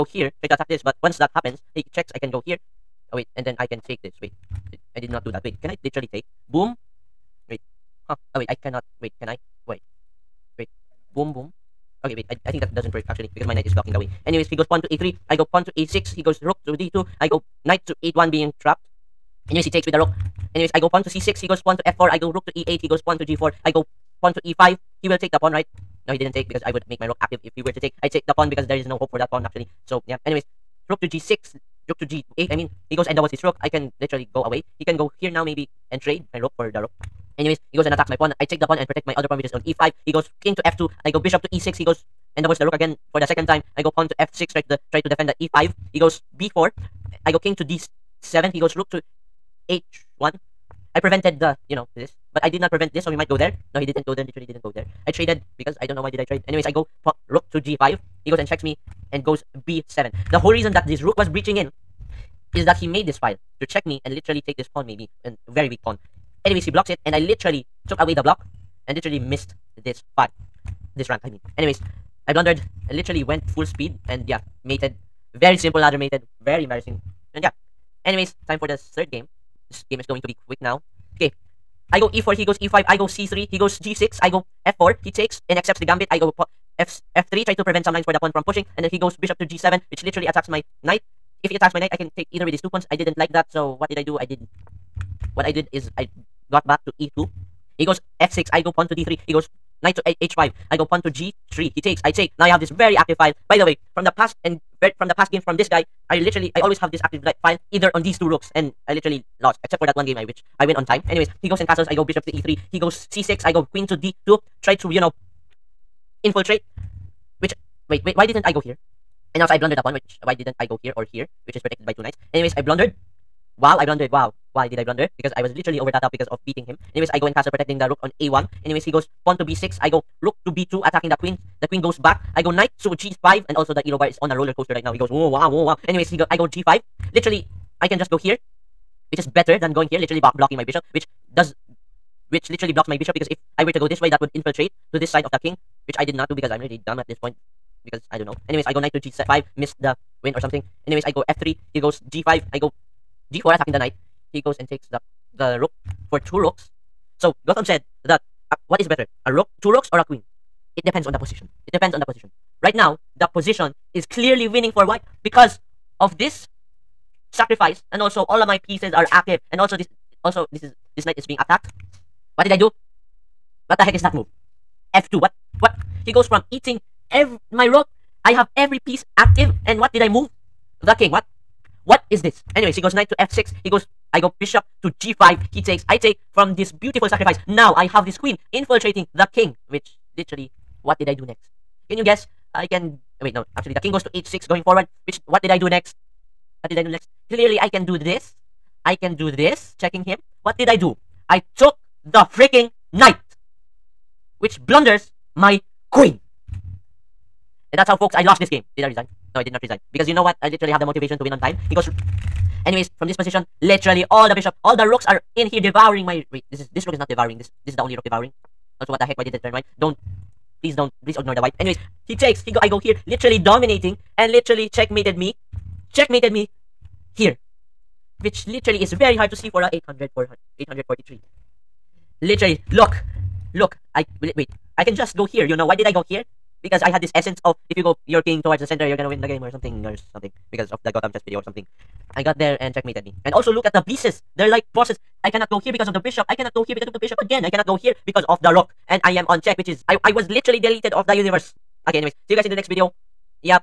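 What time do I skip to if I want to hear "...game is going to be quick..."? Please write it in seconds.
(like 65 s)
79 s.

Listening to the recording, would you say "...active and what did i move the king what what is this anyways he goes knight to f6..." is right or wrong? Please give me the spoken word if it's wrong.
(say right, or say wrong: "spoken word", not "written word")
right.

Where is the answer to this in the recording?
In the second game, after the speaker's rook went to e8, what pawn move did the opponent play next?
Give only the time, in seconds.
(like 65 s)
23 s.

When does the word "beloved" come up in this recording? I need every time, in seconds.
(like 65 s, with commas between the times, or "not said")
not said.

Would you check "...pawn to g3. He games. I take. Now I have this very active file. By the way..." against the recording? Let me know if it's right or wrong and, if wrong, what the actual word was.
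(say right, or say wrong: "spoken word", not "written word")
wrong: "takes", not "games".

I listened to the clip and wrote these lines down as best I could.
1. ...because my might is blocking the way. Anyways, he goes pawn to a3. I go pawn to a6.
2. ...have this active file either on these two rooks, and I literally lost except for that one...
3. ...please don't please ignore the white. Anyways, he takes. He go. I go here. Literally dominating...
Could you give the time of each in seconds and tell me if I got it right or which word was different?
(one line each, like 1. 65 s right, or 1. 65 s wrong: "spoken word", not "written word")
1. 13 s wrong: "knight", not "might"
2. 106 s right
3. 220 s right.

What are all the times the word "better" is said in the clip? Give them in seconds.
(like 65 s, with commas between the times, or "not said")
139 s, 158 s.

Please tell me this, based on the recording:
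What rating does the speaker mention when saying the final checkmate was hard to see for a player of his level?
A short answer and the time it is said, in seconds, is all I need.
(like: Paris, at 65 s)
843, at 230 s.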